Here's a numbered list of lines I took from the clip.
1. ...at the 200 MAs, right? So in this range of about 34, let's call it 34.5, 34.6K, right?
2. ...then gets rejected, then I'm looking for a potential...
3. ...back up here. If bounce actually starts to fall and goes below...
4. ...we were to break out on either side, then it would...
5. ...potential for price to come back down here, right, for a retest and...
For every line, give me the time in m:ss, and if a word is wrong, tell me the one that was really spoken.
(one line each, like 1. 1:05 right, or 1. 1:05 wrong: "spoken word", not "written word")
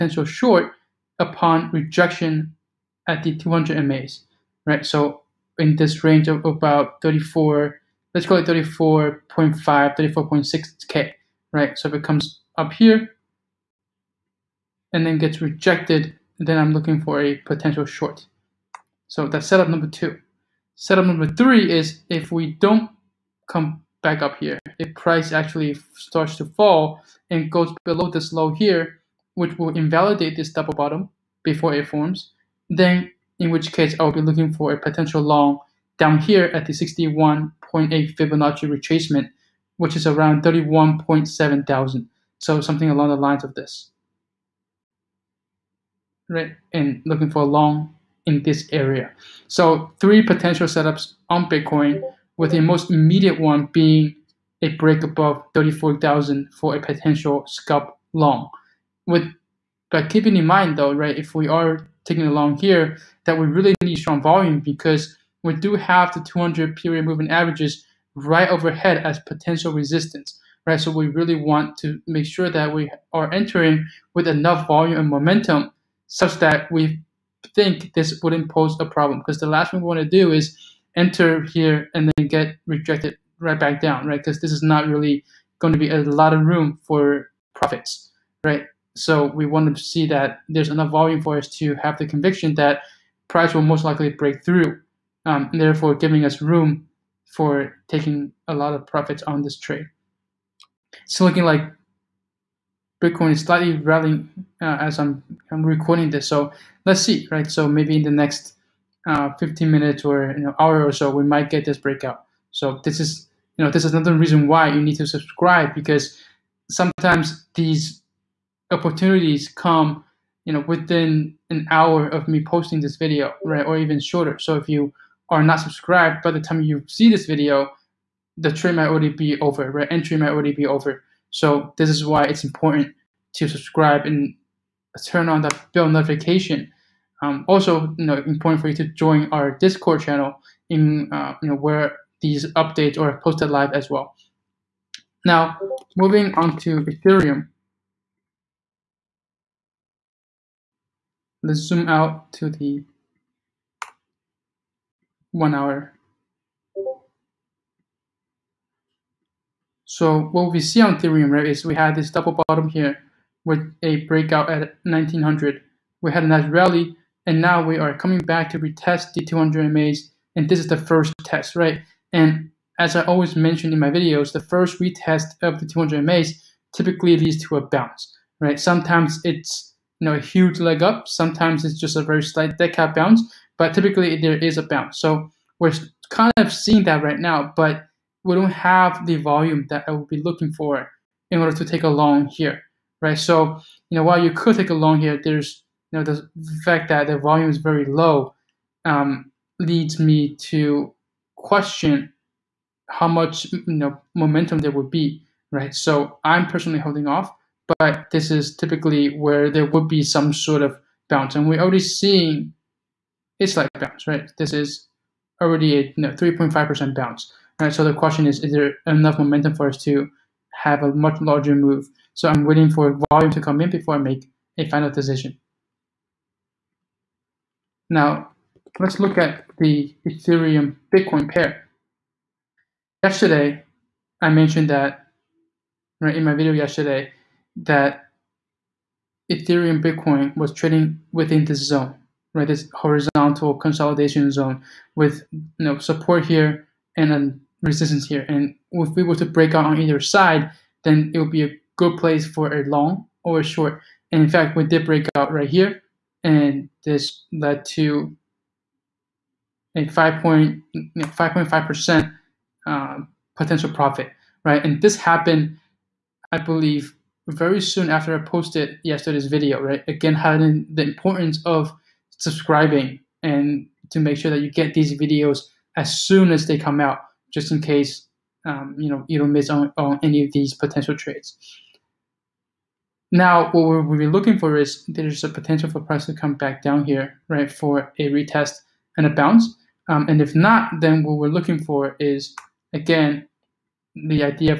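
1. 0:03 right
2. 0:15 right
3. 0:24 wrong: "price", not "bounce"
4. 4:08 right
5. 4:45 right.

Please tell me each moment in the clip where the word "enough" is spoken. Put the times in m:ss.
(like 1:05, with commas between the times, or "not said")
1:14, 1:30, 3:38.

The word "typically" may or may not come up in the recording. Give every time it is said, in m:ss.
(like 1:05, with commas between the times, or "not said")
2:56, 3:03, 3:28.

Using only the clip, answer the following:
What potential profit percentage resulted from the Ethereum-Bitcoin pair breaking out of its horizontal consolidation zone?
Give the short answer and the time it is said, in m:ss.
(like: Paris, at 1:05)
5.5 percent, at 4:19.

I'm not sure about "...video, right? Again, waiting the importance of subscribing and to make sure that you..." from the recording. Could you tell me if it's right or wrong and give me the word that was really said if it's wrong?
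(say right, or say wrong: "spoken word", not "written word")
wrong: "highlighting", not "waiting".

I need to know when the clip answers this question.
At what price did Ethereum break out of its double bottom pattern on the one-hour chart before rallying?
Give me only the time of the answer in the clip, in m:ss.
2:44.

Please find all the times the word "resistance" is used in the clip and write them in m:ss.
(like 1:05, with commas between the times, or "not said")
1:09, 4:07.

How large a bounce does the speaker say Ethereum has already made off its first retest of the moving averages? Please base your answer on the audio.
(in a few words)
3.5%.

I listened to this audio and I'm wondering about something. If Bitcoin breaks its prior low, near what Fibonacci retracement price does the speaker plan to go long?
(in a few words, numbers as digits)
31.7 thousand.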